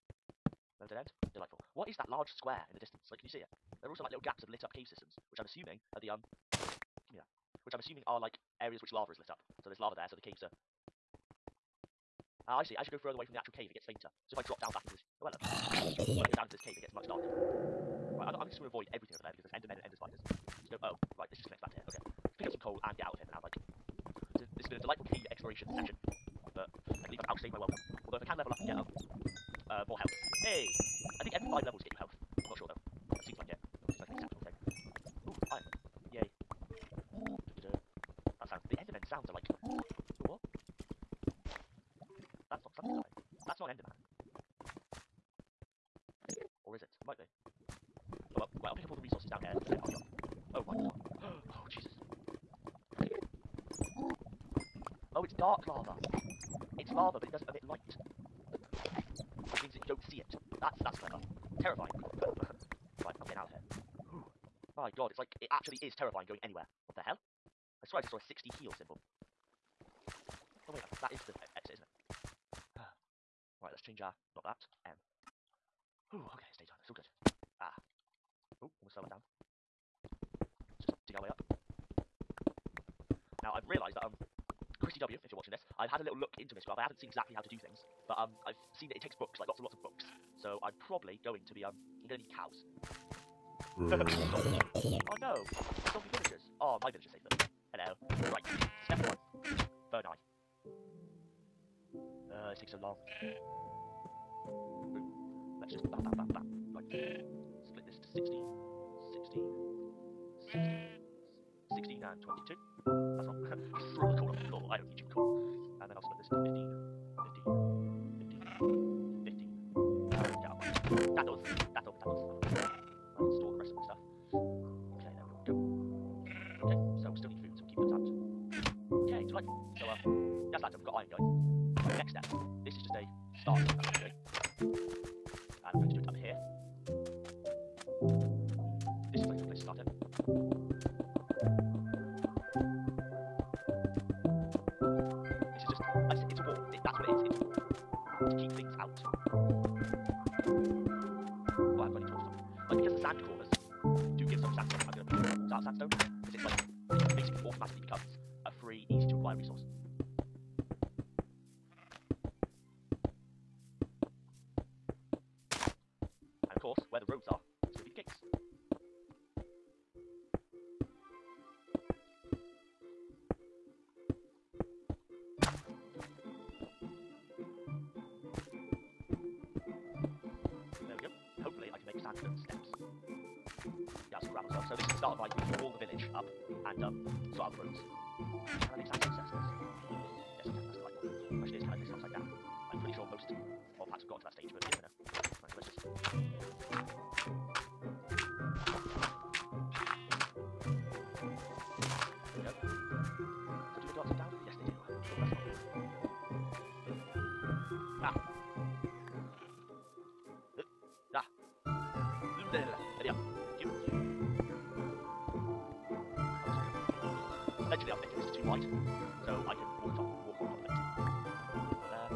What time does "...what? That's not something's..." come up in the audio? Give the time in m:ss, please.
0:40.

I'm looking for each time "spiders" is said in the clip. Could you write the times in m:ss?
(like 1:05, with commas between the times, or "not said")
0:19.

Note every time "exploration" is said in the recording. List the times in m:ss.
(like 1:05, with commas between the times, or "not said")
0:25.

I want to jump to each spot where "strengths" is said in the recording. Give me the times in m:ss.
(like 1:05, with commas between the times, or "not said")
not said.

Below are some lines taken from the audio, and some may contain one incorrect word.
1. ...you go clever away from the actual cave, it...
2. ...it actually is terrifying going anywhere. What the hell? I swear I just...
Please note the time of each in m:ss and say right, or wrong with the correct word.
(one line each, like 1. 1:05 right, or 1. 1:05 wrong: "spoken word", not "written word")
1. 0:12 wrong: "further", not "clever"
2. 1:05 right.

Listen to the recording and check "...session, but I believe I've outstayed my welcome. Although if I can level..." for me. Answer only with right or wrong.
right.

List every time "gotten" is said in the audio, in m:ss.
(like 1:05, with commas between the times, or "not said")
3:14.